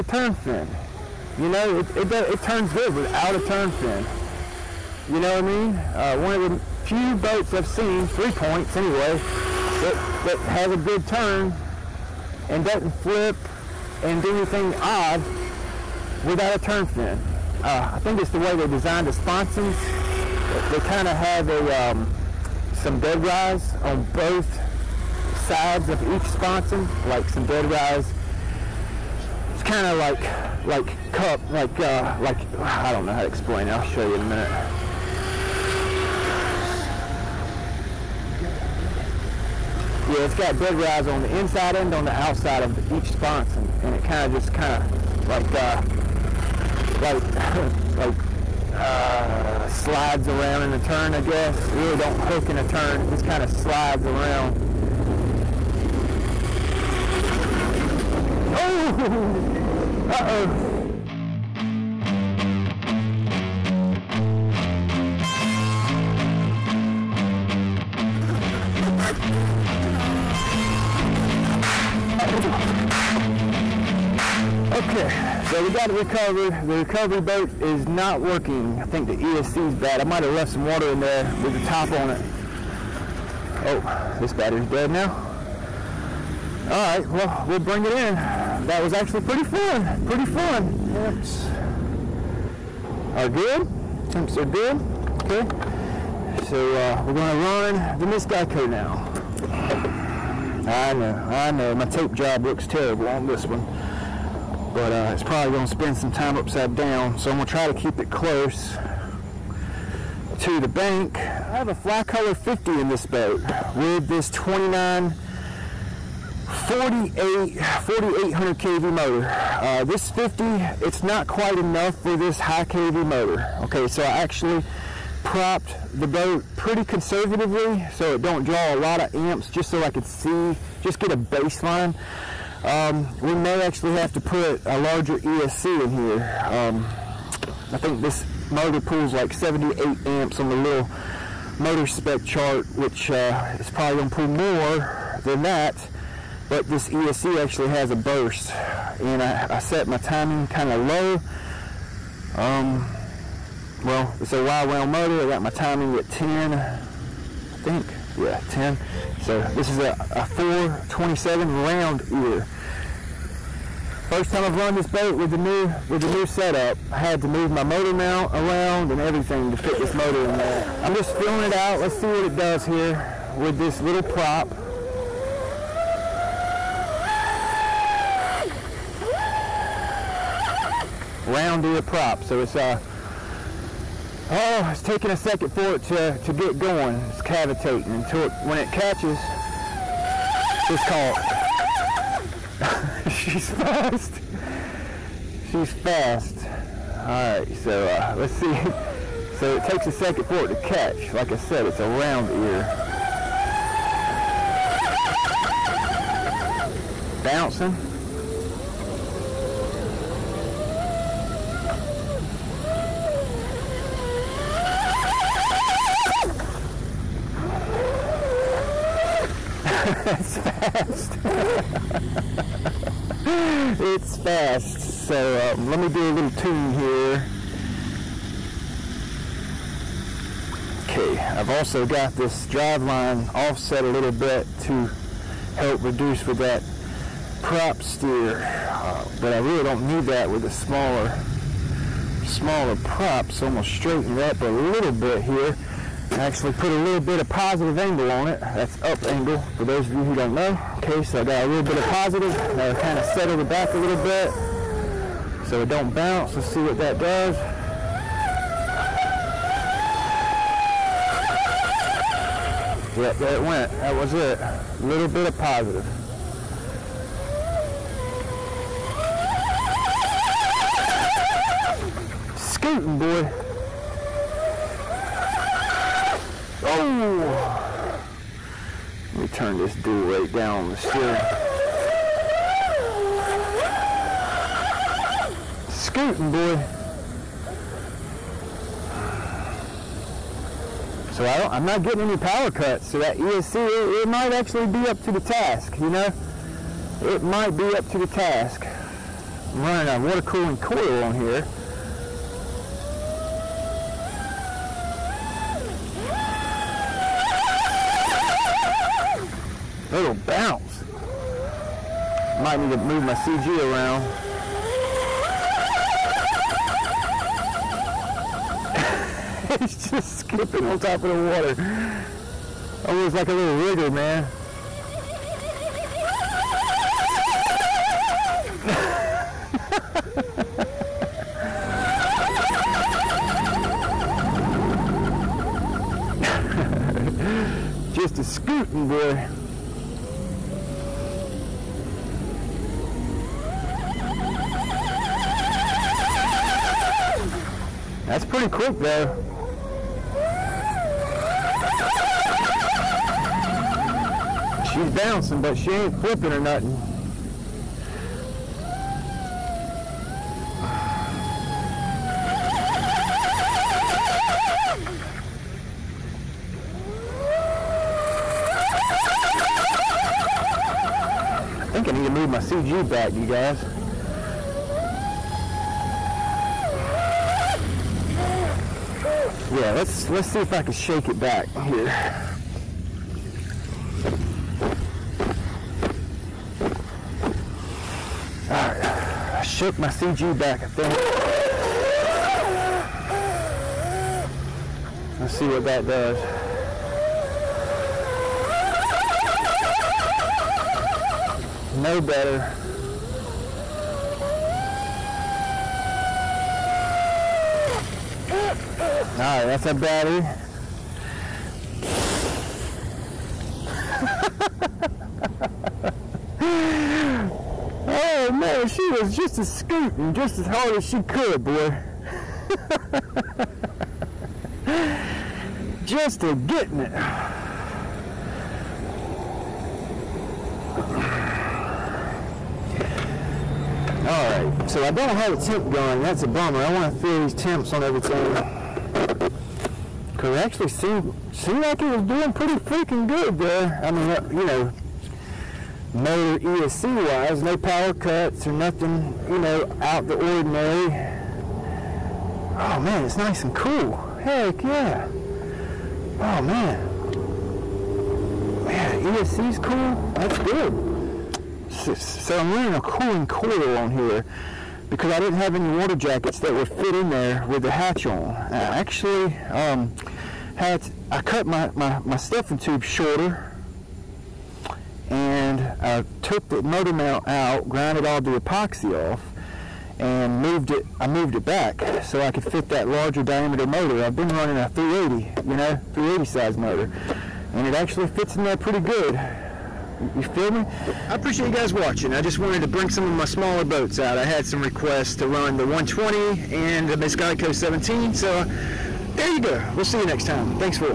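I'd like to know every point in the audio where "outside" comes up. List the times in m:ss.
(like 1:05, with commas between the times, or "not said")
0:42.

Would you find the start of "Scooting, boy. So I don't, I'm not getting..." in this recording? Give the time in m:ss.
4:45.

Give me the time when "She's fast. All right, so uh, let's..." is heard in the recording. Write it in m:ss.
3:15.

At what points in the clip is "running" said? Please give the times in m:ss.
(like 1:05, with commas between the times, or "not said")
4:59, 7:42, 8:04.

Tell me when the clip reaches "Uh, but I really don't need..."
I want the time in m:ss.
3:58.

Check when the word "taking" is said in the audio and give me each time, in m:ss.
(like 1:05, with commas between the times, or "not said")
3:04.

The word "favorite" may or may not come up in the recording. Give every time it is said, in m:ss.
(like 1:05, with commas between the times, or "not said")
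not said.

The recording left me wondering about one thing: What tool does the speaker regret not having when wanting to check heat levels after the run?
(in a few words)
temp gun.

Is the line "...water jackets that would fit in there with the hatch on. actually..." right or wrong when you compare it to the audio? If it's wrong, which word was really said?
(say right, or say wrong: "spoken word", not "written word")
right.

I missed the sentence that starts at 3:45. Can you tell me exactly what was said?
So um, let me do a little tune here.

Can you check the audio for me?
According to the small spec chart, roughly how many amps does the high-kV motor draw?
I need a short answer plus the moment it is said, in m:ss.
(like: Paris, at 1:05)
78, at 2:19.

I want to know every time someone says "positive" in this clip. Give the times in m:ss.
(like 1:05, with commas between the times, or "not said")
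4:07, 4:11, 4:25.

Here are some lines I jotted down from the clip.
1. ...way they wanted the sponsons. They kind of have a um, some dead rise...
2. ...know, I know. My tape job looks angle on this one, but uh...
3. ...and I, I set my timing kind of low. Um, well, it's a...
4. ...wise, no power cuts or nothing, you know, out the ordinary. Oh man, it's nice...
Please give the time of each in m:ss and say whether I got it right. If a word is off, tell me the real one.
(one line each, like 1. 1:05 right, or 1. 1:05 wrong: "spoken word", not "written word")
1. 0:18 wrong: "designed", not "wanted"
2. 1:40 wrong: "terrible", not "angle"
3. 2:29 right
4. 7:27 right.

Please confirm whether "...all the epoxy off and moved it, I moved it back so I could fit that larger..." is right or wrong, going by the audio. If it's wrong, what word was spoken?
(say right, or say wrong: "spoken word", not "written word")
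right.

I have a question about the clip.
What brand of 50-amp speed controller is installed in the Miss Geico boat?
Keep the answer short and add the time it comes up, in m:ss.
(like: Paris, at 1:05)
Flycolor, at 1:51.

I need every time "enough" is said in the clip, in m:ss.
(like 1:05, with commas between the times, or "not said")
2:01.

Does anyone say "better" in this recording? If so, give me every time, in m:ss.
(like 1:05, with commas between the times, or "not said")
6:41.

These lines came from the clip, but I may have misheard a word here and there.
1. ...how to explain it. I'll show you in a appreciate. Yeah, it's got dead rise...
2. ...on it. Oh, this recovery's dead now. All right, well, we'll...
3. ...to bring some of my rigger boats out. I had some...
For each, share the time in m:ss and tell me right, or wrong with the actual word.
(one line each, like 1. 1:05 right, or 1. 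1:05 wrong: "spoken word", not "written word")
1. 0:33 wrong: "minute", not "appreciate"
2. 1:21 wrong: "battery", not "recovery"
3. 8:12 wrong: "smaller", not "rigger".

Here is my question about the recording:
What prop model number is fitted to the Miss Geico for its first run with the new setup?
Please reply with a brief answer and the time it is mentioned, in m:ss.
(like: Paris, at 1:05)
427, at 2:40.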